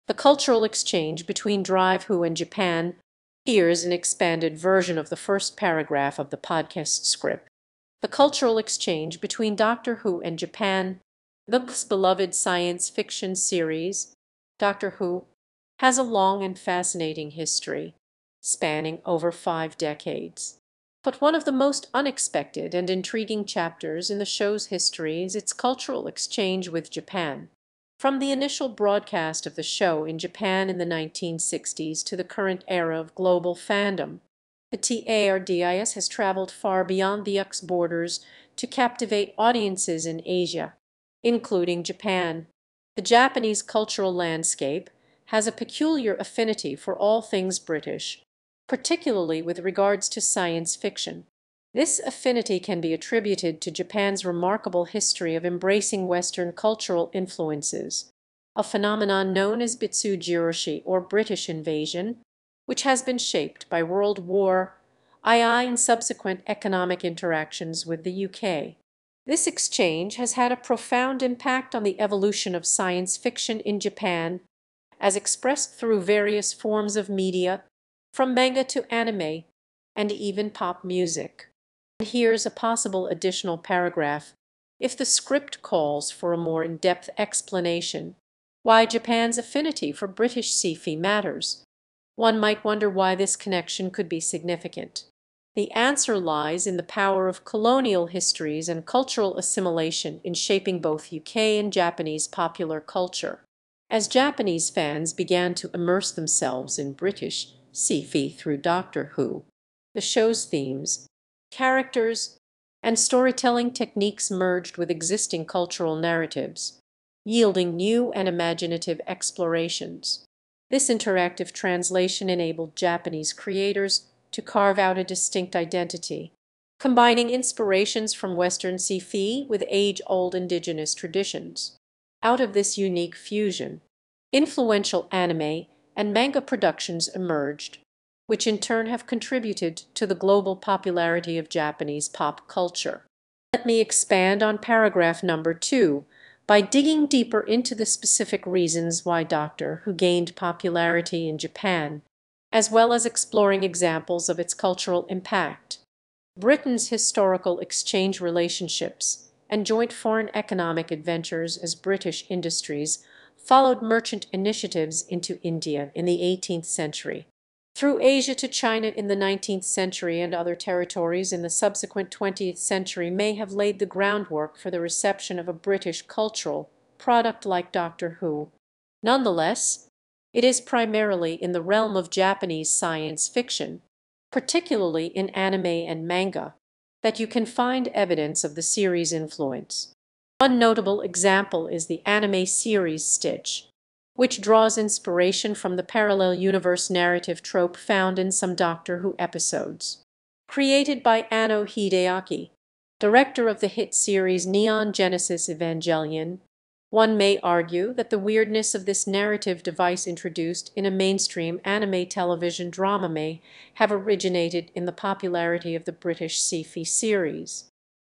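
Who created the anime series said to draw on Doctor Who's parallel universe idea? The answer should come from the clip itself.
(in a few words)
Anno Hideaki.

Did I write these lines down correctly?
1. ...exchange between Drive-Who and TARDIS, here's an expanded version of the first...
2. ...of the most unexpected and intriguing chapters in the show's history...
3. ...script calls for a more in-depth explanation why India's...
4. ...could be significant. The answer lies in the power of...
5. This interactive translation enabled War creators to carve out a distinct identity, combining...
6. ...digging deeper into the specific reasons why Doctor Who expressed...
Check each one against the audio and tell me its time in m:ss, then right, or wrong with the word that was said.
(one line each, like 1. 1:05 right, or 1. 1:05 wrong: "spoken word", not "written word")
1. 0:00 wrong: "Japan", not "TARDIS"
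2. 0:21 right
3. 1:25 wrong: "Japan", not "India"
4. 1:33 right
5. 2:00 wrong: "Japanese", not "War"
6. 2:26 wrong: "gained", not "expressed".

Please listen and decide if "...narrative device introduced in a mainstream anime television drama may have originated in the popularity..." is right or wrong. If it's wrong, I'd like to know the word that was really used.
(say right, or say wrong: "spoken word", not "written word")
right.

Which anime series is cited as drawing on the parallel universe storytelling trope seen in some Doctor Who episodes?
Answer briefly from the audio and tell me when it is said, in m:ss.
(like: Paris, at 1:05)
Stitch, at 3:13.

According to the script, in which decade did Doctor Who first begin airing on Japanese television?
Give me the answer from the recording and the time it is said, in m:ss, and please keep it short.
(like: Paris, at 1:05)
1960s, at 0:30.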